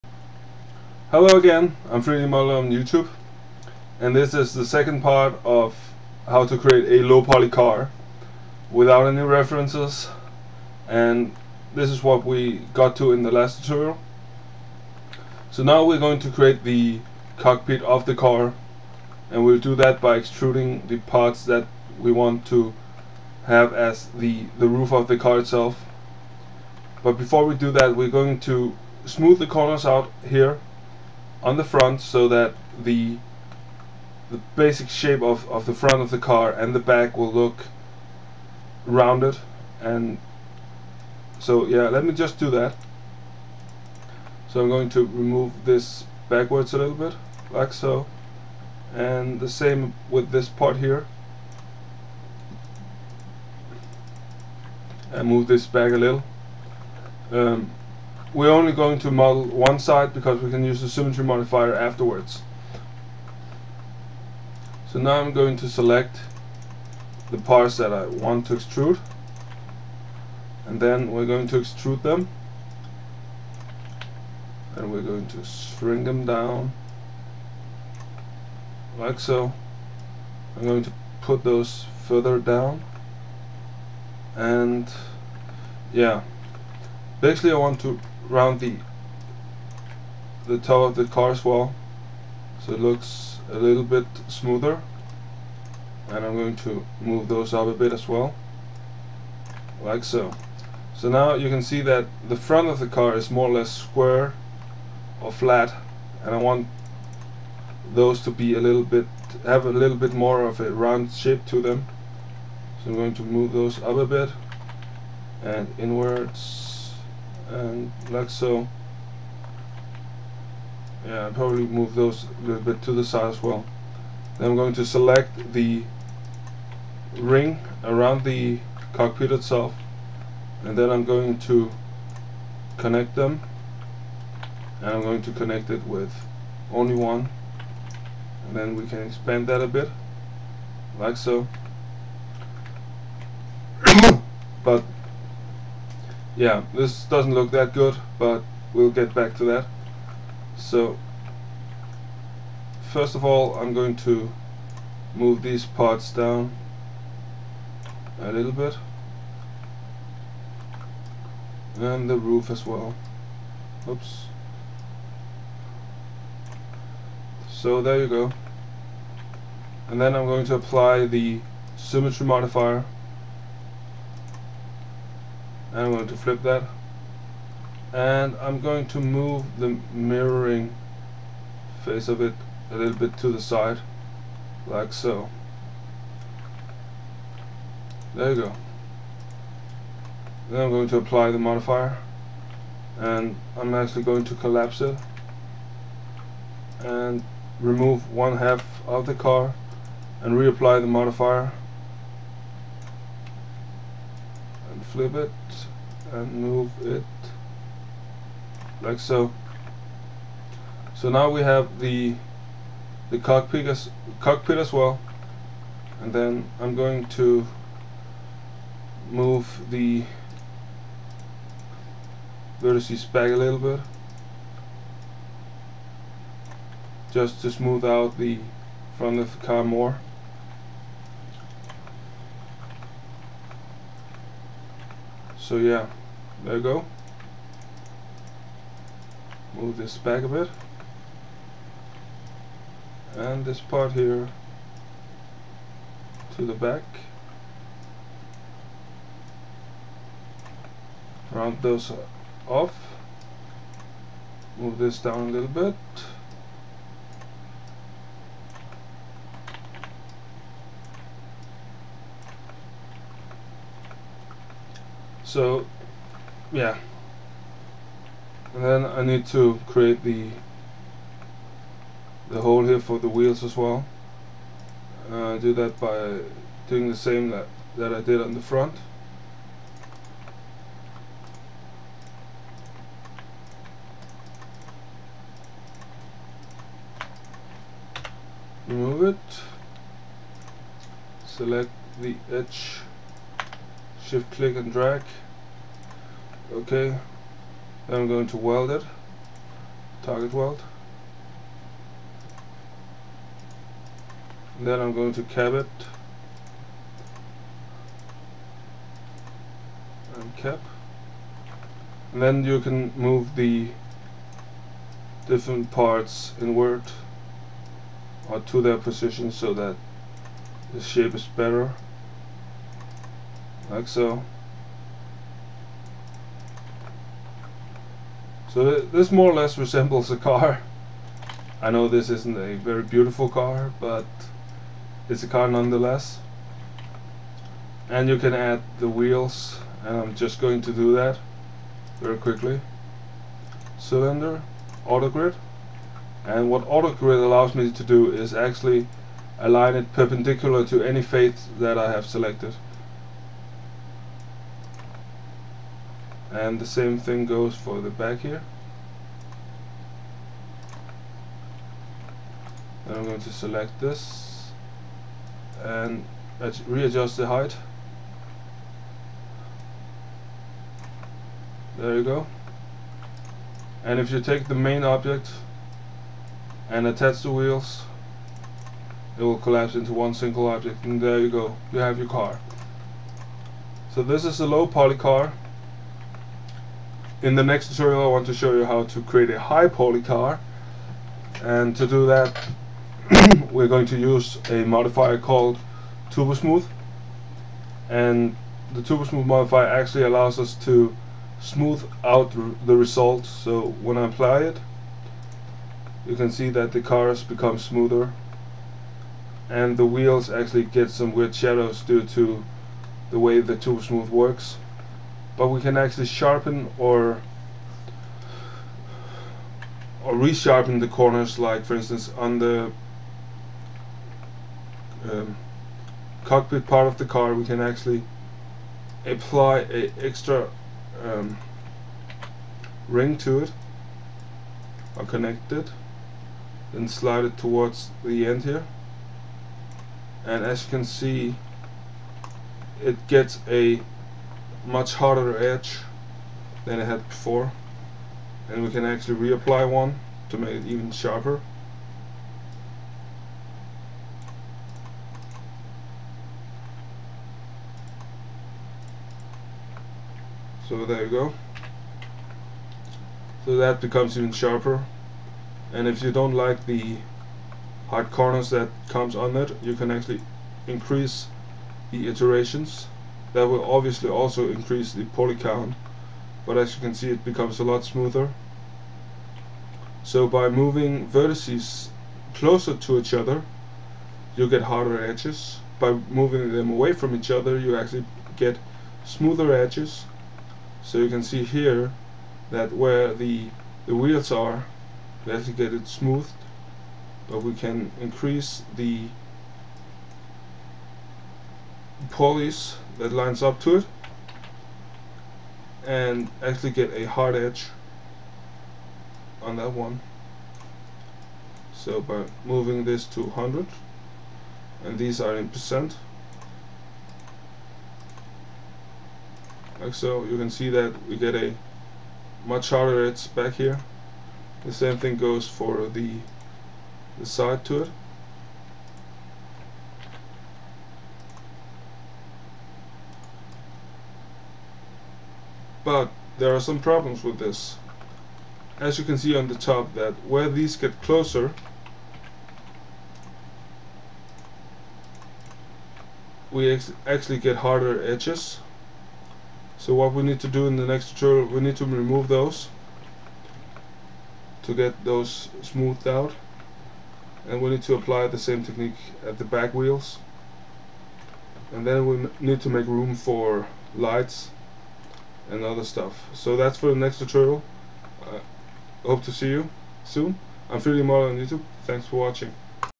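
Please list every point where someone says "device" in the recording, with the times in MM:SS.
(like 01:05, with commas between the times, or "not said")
not said.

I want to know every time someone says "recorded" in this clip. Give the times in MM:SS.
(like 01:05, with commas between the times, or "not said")
not said.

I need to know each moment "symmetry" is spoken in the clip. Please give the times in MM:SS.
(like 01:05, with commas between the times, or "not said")
01:00, 02:51.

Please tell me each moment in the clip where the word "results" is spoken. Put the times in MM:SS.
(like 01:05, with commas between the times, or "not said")
06:42.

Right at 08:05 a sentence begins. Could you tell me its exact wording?
By moving them away from each other, you actually get smoother edges.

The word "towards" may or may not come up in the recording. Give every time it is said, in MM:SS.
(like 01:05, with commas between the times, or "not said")
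07:17.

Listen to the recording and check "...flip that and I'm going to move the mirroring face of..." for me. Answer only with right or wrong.
right.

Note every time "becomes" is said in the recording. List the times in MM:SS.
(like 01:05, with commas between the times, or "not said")
06:47, 07:43, 07:57.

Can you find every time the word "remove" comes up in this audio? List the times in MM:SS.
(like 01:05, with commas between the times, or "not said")
00:45, 03:17, 04:48, 09:11.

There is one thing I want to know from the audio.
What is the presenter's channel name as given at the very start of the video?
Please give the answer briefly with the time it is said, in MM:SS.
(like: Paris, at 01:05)
3dmoddeler, at 00:02.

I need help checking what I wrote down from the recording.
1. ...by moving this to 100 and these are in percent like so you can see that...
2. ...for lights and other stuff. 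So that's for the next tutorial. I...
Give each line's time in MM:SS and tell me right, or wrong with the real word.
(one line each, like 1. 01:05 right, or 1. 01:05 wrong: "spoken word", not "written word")
1. 08:32 right
2. 09:23 right.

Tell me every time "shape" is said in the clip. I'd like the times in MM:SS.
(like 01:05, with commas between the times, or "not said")
00:34, 01:51, 05:20.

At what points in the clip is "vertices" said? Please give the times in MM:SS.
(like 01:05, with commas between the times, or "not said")
03:42, 08:01.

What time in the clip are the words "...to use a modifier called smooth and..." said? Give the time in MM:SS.
06:33.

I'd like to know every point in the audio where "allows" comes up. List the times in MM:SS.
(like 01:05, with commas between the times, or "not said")
05:47, 06:40.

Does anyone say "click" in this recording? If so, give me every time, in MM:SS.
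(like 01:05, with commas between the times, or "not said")
04:54.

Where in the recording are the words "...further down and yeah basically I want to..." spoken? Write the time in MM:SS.
01:22.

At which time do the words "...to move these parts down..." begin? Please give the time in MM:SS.
02:33.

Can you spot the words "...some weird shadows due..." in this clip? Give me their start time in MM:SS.
06:50.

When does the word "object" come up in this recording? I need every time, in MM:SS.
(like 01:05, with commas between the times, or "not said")
06:14, 06:20.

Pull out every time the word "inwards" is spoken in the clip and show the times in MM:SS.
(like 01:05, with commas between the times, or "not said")
01:55, 05:16.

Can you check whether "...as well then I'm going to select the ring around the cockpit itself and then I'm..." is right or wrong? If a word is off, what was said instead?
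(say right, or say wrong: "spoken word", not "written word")
right.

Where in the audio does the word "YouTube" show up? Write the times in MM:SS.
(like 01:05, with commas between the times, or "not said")
00:02, 09:31.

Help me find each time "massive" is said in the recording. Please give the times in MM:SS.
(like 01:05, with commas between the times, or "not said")
not said.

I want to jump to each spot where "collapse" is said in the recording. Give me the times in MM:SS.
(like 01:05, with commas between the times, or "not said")
03:14, 06:19.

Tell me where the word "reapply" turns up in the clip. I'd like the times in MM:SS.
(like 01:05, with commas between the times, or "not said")
03:20, 07:29.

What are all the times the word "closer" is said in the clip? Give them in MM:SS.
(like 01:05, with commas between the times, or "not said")
08:02, 09:01.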